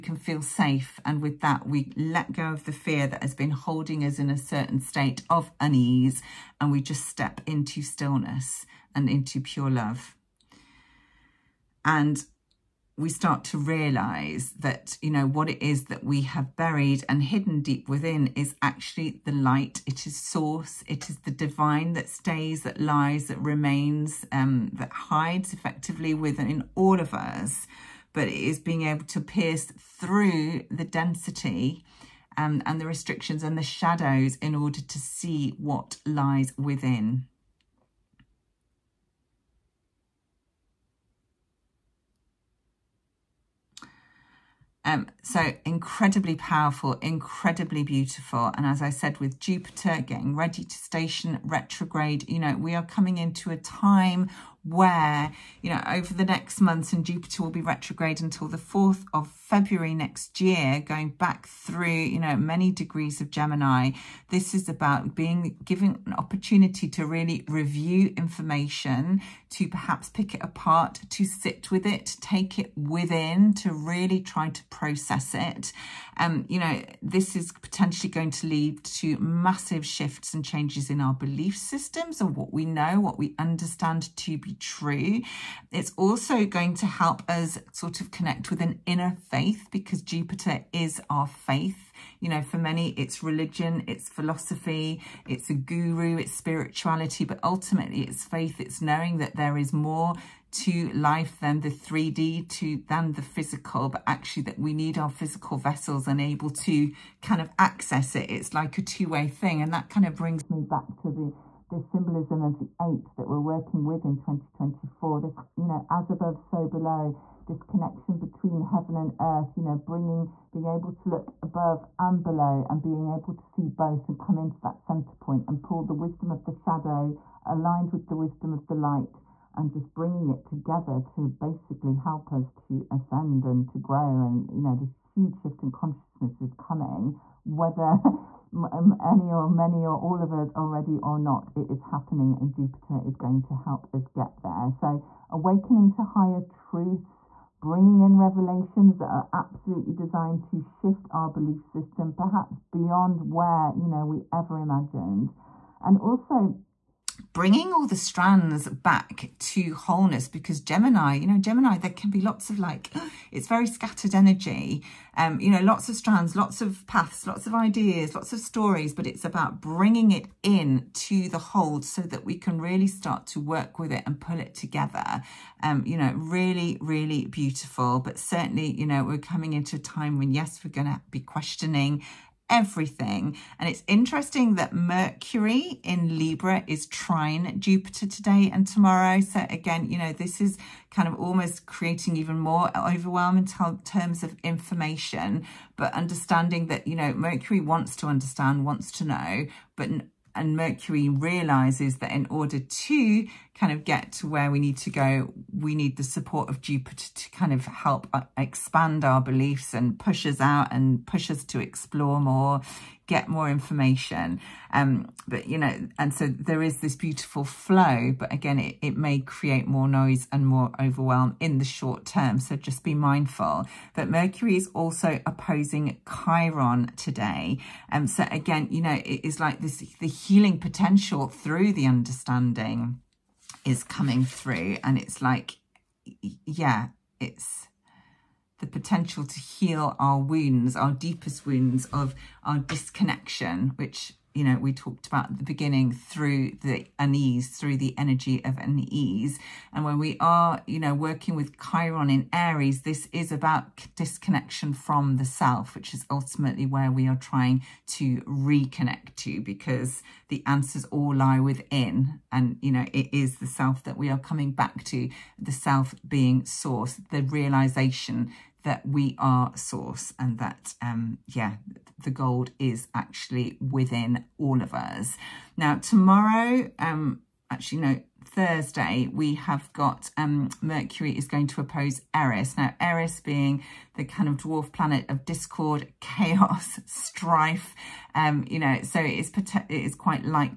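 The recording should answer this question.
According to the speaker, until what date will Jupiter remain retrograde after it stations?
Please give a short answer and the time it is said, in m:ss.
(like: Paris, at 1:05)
4 February, at 0:58.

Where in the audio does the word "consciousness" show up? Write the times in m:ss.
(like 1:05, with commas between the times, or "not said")
2:15.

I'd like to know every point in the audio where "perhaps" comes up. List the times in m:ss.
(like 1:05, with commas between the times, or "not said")
1:09, 2:32.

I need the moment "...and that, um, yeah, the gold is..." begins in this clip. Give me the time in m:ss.
4:30.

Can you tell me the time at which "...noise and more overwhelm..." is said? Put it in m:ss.
3:39.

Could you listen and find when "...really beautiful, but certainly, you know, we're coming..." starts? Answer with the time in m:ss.
2:56.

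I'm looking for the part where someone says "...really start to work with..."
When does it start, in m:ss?
2:52.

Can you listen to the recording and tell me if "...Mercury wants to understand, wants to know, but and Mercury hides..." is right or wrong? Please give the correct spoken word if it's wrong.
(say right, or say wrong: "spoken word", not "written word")
wrong: "realizes", not "hides".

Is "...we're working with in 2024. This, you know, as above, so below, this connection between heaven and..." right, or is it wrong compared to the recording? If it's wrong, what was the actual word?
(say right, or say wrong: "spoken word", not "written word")
right.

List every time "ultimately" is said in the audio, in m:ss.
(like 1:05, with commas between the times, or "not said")
1:37, 4:16.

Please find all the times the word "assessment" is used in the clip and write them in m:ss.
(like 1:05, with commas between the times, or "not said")
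not said.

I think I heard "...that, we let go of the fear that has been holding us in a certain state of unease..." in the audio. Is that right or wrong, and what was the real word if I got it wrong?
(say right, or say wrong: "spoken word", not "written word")
right.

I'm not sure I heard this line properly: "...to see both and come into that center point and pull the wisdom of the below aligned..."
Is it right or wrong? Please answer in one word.
wrong.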